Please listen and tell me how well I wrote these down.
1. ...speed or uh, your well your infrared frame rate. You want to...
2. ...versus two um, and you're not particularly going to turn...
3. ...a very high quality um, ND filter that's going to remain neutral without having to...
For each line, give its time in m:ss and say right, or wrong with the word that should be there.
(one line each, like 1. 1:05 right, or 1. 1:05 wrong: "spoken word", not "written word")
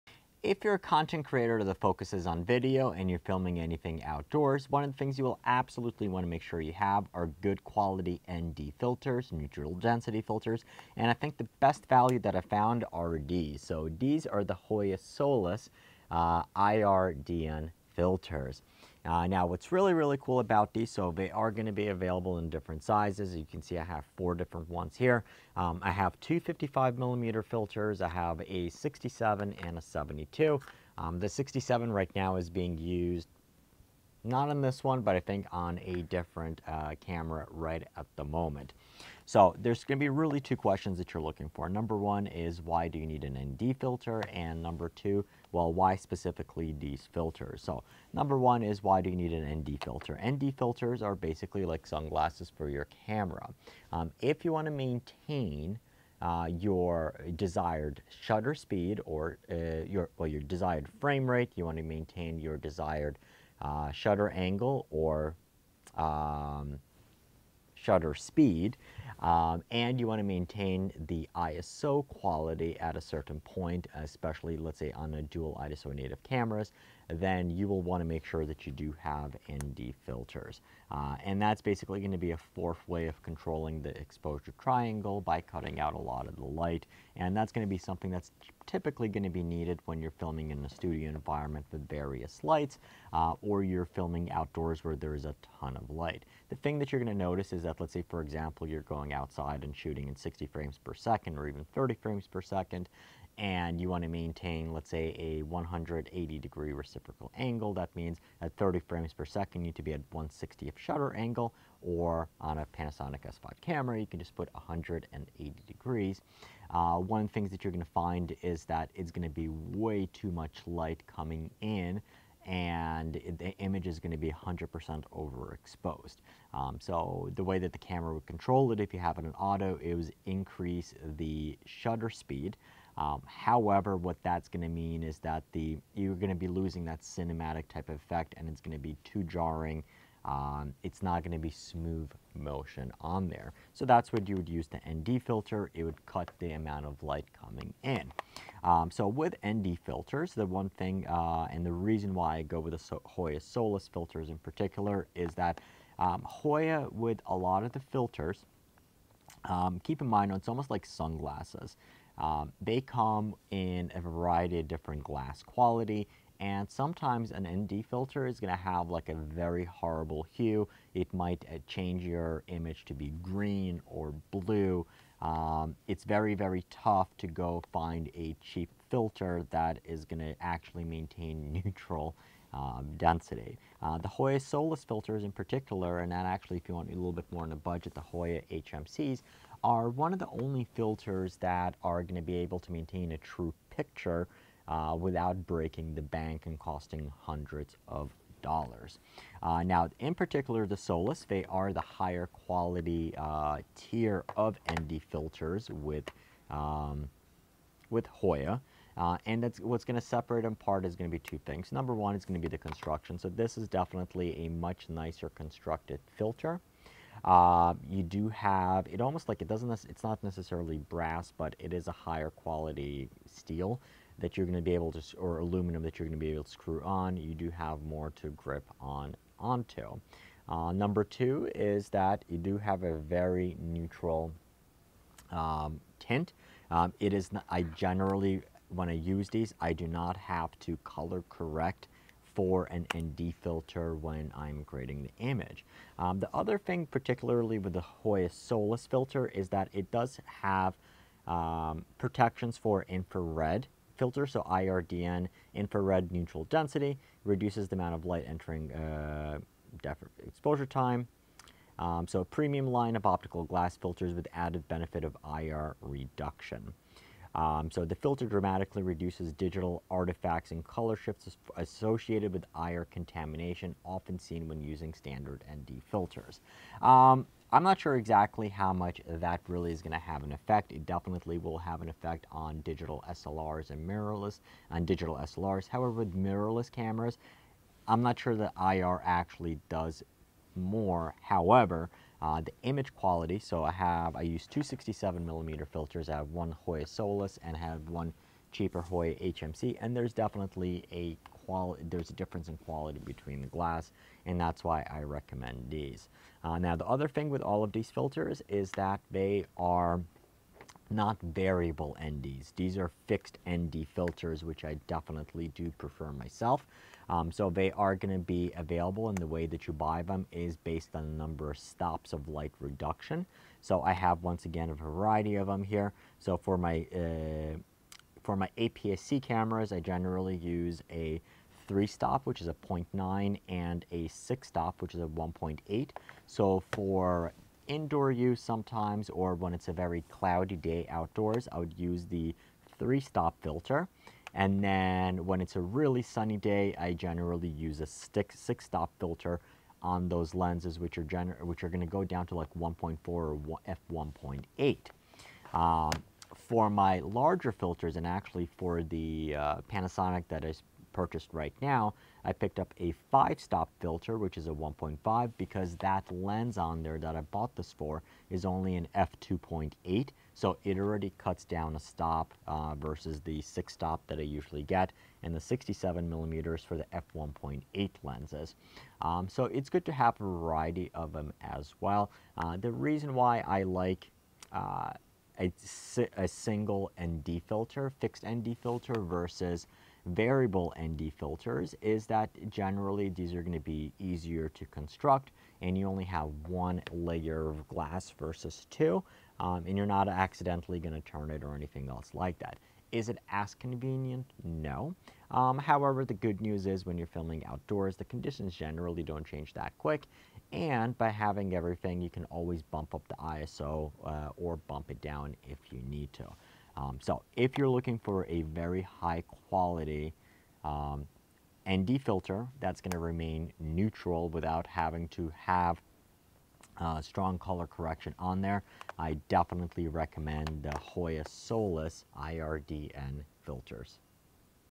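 1. 0:58 wrong: "desired", not "infrared"
2. 6:38 wrong: "accidentally", not "particularly"
3. 6:58 right.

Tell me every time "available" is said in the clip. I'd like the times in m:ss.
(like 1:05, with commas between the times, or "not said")
0:21, 5:18.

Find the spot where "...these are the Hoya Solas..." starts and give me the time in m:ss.
0:13.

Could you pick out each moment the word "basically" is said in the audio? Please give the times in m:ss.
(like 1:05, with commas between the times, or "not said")
0:51, 1:21.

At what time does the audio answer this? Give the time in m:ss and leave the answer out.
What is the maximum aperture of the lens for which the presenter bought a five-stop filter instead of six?
6:08.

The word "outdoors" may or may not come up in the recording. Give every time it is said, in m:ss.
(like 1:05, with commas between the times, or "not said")
0:04, 1:34, 5:40, 6:47.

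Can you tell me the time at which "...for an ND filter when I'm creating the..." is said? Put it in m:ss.
4:02.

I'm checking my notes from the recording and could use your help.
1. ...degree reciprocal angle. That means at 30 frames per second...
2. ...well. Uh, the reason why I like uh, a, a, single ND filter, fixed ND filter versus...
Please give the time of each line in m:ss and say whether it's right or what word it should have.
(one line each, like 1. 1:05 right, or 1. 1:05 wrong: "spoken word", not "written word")
1. 1:46 right
2. 6:21 right.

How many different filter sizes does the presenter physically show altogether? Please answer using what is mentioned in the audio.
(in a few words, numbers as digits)
4.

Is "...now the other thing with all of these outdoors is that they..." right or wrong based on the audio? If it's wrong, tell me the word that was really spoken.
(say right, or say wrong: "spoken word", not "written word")
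wrong: "filters", not "outdoors".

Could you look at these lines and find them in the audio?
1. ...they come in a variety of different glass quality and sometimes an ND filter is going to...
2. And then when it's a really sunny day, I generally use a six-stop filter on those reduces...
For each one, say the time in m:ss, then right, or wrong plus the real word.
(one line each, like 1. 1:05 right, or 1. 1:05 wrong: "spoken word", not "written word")
1. 2:42 right
2. 5:44 wrong: "lenses", not "reduces".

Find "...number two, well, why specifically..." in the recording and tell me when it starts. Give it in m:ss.
0:44.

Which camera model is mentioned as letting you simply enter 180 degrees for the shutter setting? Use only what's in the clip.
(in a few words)
Panasonic S5.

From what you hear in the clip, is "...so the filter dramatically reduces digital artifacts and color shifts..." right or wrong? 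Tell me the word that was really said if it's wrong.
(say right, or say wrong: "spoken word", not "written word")
right.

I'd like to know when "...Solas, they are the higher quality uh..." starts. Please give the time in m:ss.
3:20.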